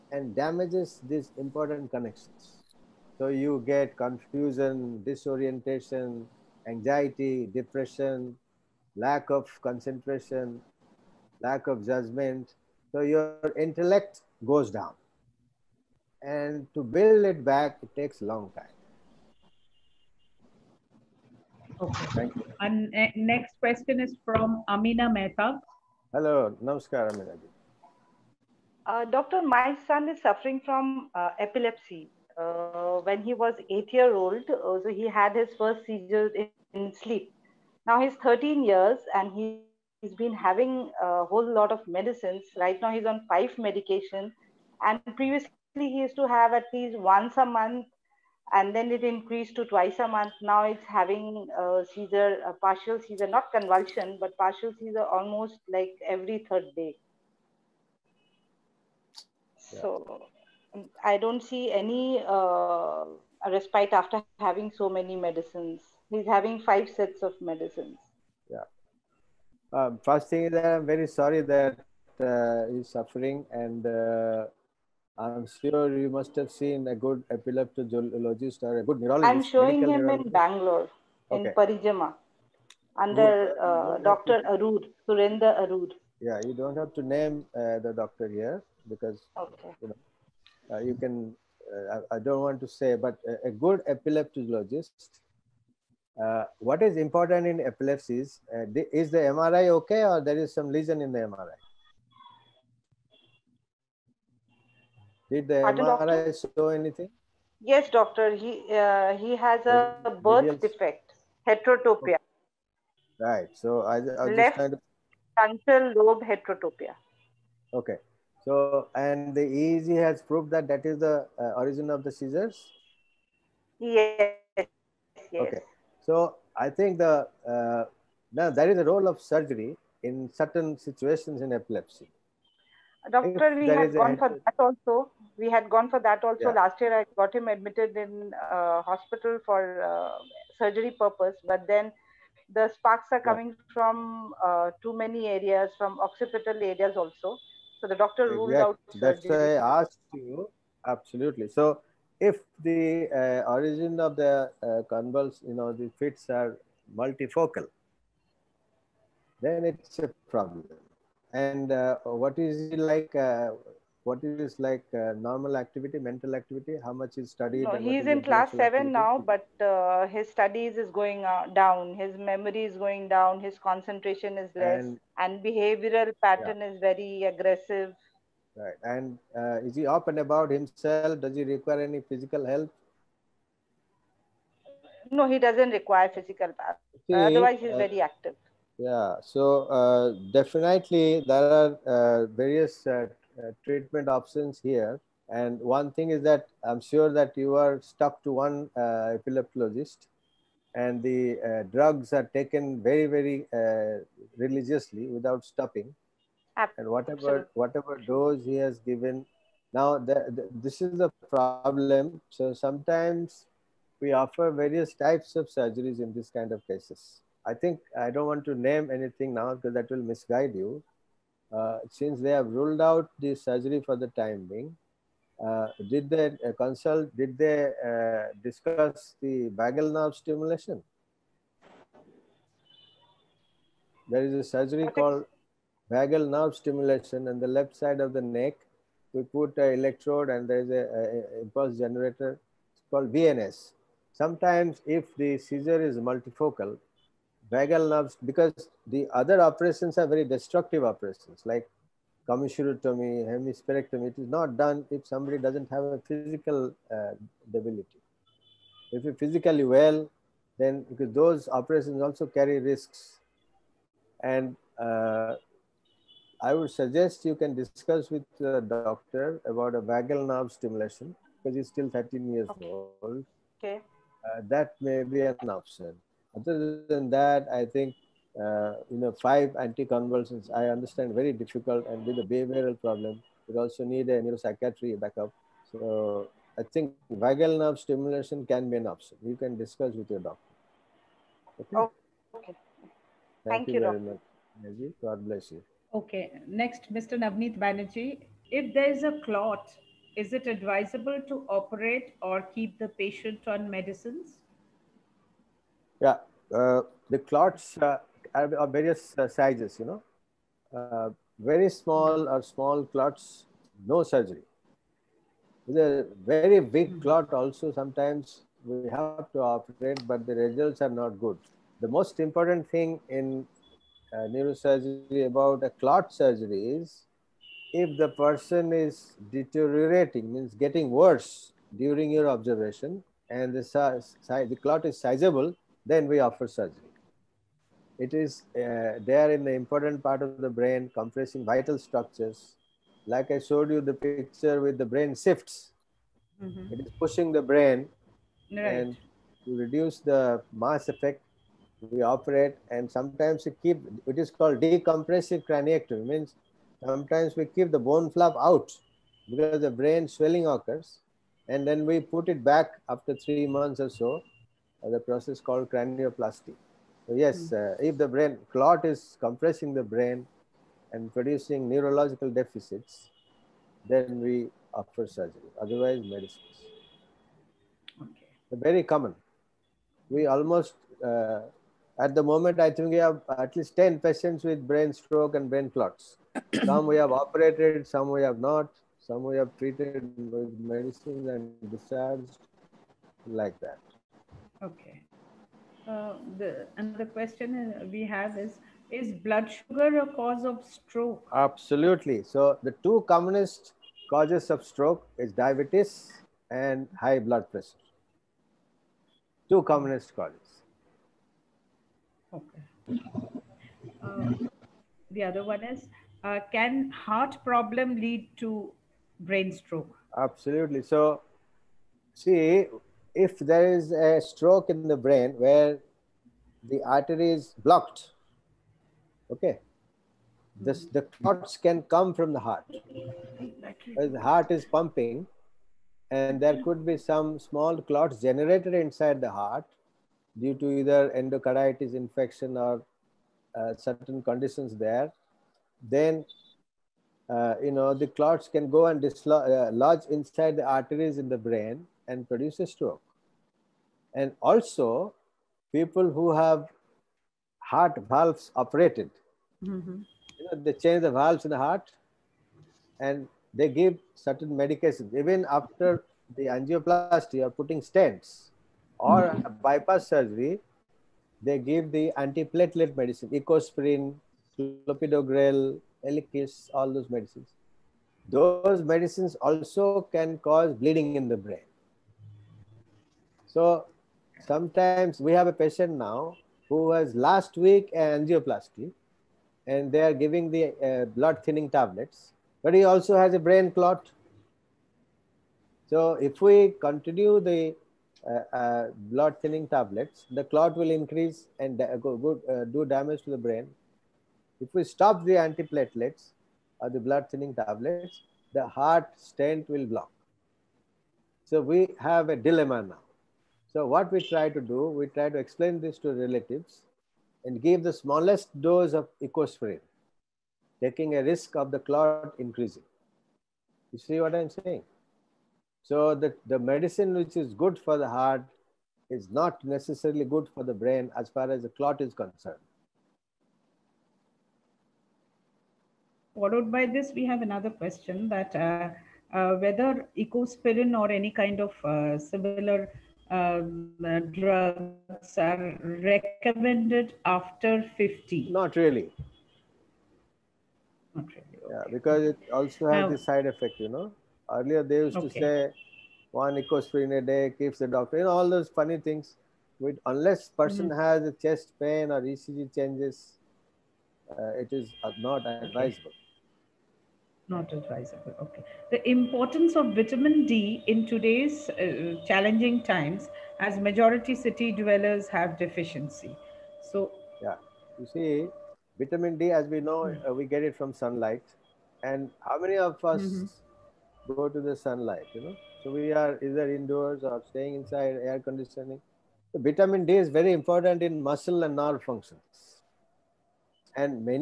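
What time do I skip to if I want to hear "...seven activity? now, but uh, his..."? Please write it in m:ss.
2:48.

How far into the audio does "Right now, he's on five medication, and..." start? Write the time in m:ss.
0:42.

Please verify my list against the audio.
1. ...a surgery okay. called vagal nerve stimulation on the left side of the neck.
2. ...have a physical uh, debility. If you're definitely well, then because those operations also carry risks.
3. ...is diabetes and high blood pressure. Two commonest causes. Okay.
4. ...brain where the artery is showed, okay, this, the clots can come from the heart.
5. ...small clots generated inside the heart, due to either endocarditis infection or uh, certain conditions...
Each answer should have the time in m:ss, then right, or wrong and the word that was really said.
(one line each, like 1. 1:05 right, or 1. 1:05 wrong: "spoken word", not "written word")
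1. 3:54 right
2. 4:15 wrong: "physically", not "definitely"
3. 6:45 right
4. 7:04 wrong: "blocked", not "showed"
5. 7:17 right.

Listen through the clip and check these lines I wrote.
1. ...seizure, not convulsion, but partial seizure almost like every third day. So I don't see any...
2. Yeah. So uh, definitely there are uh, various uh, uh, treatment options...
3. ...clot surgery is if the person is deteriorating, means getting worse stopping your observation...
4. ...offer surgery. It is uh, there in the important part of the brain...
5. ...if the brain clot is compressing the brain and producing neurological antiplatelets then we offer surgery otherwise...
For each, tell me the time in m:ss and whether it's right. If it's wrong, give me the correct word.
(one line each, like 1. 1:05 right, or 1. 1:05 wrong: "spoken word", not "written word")
1. 0:53 right
2. 3:08 right
3. 5:25 wrong: "during", not "stopping"
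4. 5:36 right
5. 6:07 wrong: "deficits", not "antiplatelets".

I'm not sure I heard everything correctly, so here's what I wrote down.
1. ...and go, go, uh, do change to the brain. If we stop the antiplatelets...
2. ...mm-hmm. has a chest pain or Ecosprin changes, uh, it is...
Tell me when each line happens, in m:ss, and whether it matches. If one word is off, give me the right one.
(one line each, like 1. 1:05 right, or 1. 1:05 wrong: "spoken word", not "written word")
1. 8:21 wrong: "damage", not "change"
2. 9:20 wrong: "ECG", not "Ecosprin".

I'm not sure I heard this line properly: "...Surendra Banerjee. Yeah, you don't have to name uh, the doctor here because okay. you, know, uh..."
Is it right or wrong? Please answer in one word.
wrong.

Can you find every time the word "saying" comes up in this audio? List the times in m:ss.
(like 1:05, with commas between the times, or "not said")
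8:44.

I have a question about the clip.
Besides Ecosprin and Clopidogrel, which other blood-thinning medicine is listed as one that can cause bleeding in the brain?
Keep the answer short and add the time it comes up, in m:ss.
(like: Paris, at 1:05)
Eliquis, at 7:56.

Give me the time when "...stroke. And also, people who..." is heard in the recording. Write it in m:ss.
7:32.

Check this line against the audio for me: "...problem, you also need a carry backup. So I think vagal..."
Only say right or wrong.
wrong.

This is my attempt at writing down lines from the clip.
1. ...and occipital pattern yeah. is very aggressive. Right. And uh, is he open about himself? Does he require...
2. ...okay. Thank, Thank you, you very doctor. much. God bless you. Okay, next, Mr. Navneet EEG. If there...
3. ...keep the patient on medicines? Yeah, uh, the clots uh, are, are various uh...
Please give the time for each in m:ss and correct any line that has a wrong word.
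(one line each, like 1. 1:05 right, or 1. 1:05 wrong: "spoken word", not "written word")
1. 2:55 wrong: "behavioral", not "occipital"
2. 4:52 wrong: "Banerjee", not "EEG"
3. 5:02 right.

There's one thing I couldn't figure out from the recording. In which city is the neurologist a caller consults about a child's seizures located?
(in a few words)
Bangalore.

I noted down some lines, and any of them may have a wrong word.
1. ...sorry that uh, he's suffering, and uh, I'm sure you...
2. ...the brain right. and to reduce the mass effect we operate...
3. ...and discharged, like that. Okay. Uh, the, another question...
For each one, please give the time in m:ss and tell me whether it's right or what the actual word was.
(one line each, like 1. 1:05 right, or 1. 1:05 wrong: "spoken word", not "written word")
1. 1:11 right
2. 5:47 right
3. 6:31 right.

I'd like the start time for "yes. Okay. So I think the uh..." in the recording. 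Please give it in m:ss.
2:04.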